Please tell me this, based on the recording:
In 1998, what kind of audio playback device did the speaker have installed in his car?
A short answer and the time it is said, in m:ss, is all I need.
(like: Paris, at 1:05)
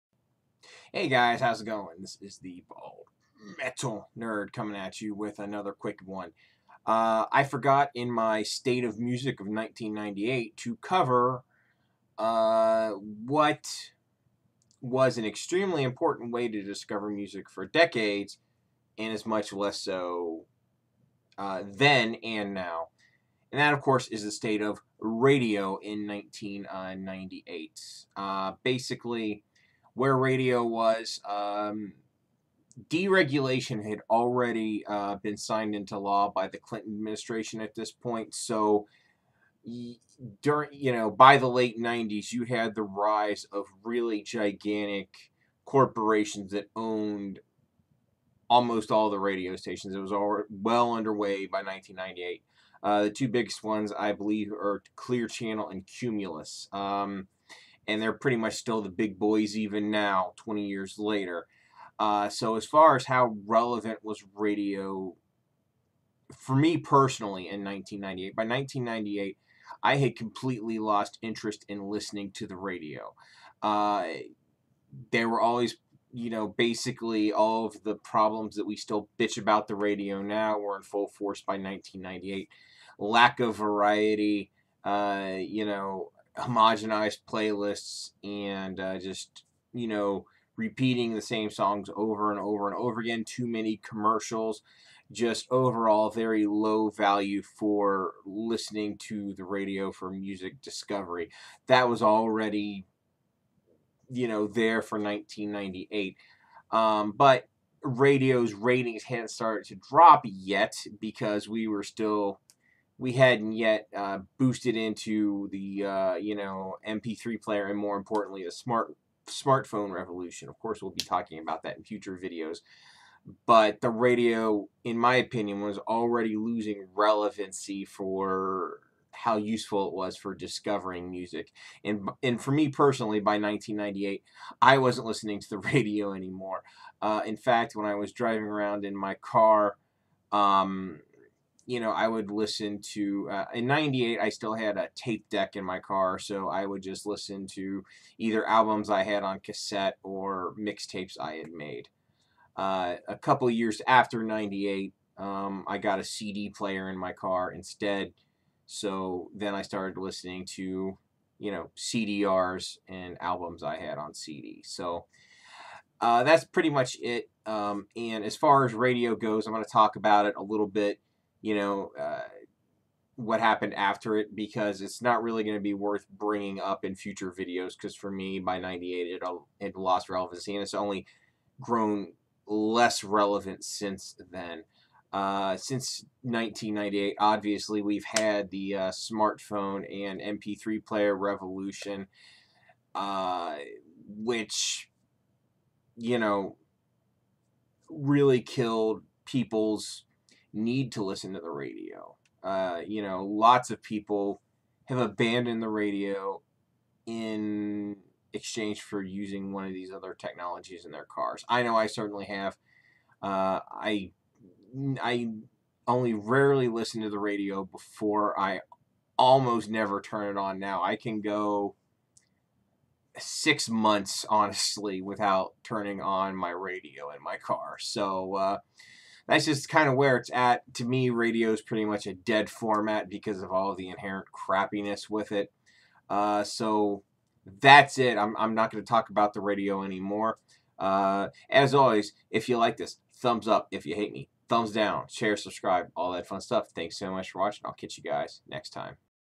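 A tape deck, at 2:24.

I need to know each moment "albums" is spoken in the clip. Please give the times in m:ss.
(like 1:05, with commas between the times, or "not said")
2:28, 2:43.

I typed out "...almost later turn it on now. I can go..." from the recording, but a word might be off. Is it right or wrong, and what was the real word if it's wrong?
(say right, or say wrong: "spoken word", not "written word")
wrong: "never", not "later".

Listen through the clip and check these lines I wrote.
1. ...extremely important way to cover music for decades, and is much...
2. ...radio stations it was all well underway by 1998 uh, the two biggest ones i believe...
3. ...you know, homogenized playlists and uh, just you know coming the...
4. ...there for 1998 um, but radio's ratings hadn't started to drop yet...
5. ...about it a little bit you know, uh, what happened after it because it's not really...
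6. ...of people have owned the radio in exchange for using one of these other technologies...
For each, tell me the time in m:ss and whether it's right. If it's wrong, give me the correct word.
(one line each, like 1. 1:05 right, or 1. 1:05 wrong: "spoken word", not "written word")
1. 0:15 wrong: "discover", not "cover"
2. 0:49 right
3. 1:25 wrong: "repeating", not "coming"
4. 1:44 right
5. 2:49 right
6. 3:23 wrong: "abandoned", not "owned".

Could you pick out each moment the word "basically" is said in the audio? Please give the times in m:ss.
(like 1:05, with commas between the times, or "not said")
0:28, 1:16.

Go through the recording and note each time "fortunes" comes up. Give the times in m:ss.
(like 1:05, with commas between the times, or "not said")
not said.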